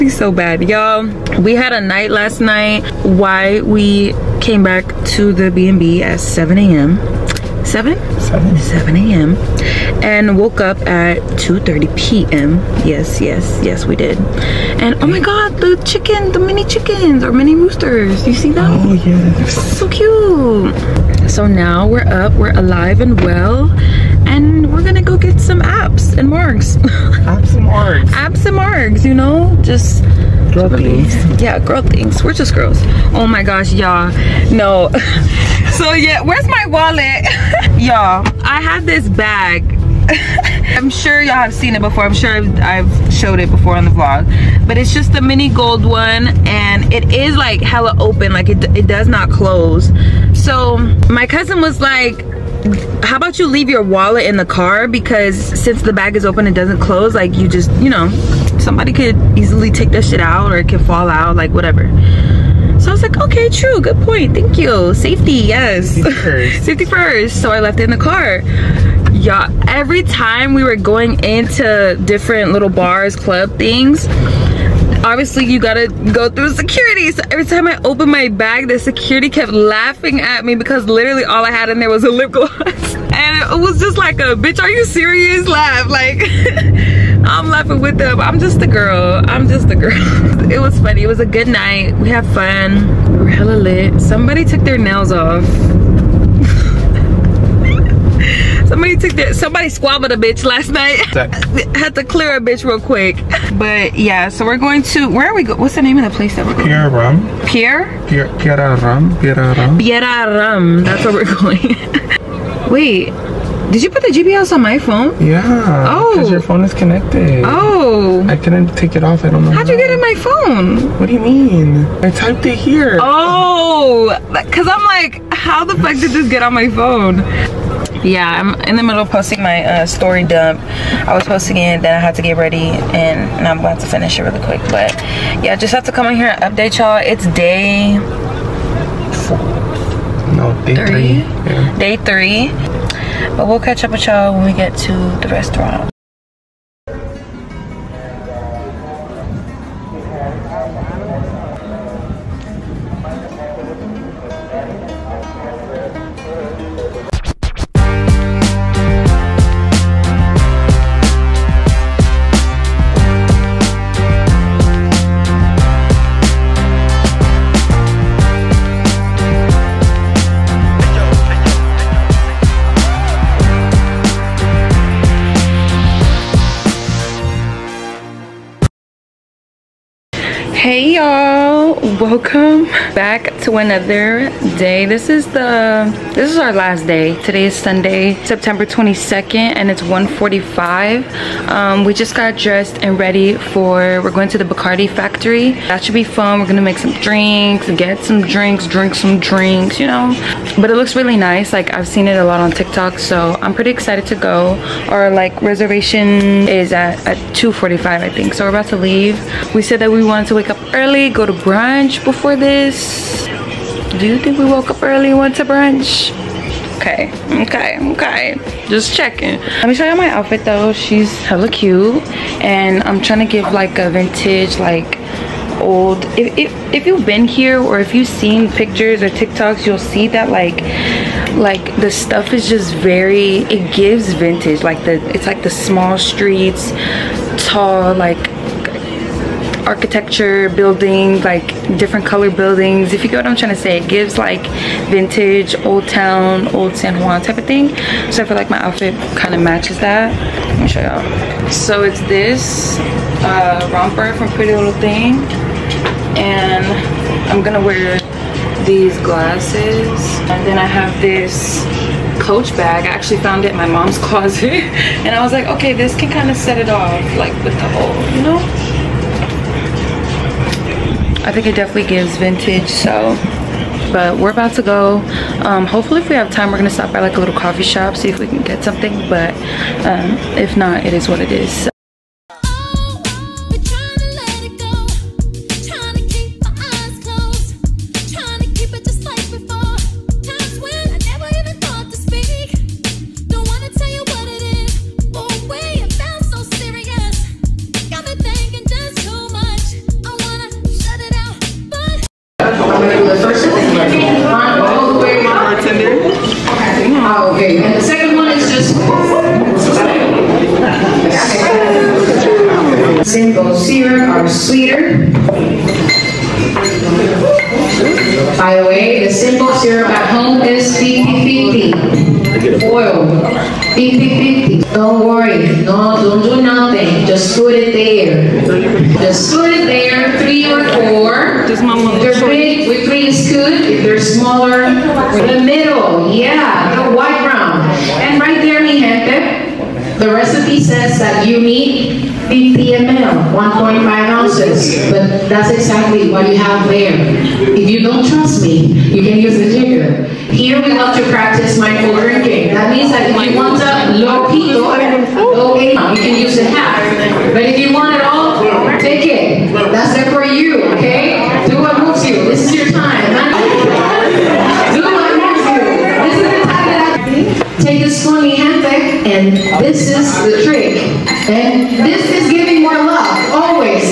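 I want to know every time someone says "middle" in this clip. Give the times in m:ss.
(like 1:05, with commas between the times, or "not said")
2:08, 5:35.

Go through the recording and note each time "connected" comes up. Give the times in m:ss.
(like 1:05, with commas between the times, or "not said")
1:56.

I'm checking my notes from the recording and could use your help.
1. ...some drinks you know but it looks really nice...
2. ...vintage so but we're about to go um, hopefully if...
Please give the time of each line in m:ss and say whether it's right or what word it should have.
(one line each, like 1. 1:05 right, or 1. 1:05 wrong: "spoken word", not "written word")
1. 3:18 right
2. 4:32 right.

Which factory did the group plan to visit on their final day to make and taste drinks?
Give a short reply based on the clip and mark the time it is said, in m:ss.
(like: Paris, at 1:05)
Bacardi factory, at 3:14.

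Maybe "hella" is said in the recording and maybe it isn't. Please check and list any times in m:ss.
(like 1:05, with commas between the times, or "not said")
0:47, 1:33, 3:41.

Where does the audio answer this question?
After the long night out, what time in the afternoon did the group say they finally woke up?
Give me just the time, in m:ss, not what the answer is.
0:11.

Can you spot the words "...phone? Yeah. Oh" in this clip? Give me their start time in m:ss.
1:54.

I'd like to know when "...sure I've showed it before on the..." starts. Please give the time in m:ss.
0:42.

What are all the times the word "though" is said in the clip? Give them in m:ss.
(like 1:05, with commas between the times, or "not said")
3:40.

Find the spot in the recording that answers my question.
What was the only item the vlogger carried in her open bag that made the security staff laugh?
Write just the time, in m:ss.
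1:22.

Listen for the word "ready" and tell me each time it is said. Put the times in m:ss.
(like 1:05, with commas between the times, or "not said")
2:12, 3:12.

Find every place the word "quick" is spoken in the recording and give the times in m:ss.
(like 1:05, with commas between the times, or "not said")
1:42, 2:14.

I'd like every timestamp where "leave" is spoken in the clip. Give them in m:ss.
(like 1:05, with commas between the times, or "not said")
0:53, 3:28.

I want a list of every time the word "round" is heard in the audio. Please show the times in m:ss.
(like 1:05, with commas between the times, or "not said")
5:37.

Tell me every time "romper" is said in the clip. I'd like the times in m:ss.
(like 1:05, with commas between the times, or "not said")
4:13.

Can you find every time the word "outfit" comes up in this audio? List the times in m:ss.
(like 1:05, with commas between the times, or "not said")
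3:40, 4:08.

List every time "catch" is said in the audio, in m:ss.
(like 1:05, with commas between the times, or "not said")
2:23.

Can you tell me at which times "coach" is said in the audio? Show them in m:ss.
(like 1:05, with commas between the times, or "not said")
4:22.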